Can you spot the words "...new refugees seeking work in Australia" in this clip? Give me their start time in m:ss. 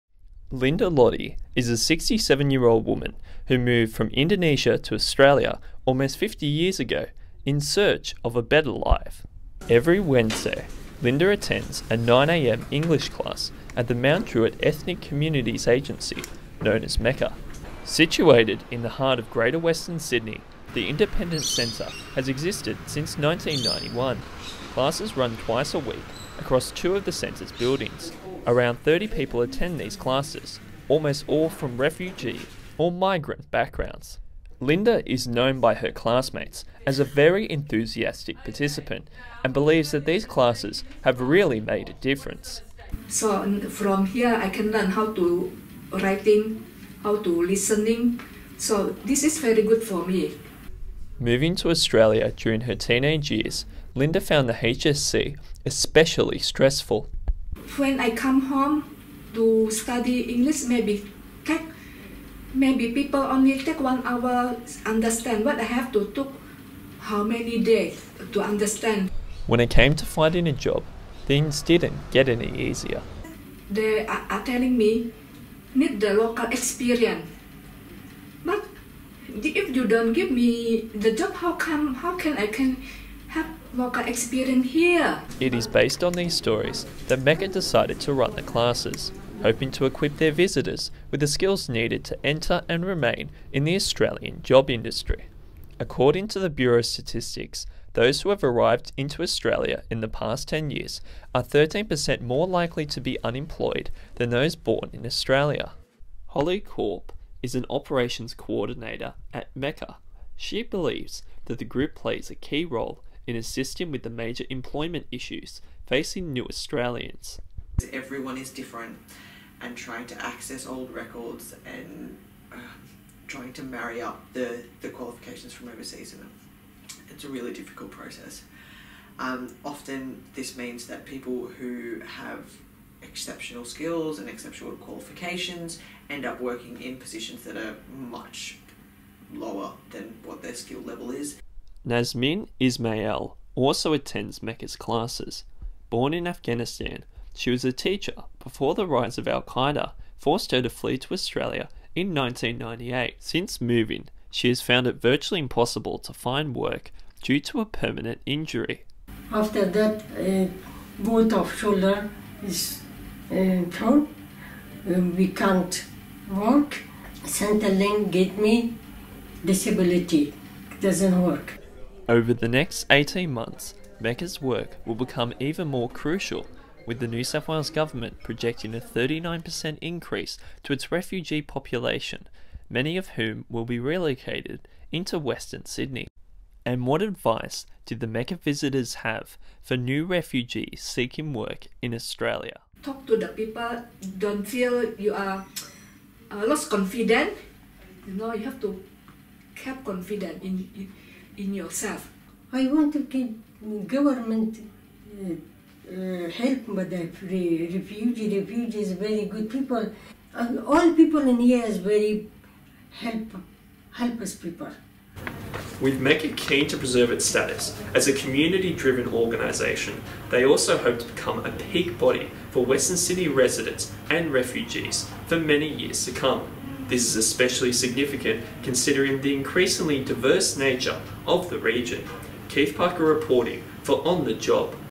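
3:09.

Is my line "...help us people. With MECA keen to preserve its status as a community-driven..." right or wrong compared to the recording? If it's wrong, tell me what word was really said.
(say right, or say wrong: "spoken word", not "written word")
right.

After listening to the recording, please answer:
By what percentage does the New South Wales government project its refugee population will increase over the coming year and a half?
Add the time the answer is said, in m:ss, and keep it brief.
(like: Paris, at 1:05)
39%, at 2:58.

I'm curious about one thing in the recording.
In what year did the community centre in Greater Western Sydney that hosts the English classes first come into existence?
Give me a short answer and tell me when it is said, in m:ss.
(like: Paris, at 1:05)
1991, at 0:23.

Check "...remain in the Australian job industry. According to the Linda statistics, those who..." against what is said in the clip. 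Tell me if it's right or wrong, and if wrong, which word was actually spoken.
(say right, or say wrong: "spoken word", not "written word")
wrong: "Bureau", not "Linda".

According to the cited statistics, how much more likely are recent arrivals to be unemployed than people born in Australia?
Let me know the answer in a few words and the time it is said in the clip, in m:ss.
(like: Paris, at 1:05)
13%, at 1:41.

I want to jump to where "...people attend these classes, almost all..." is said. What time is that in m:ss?
0:29.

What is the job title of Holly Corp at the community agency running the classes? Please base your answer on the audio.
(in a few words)
Operations coordinator.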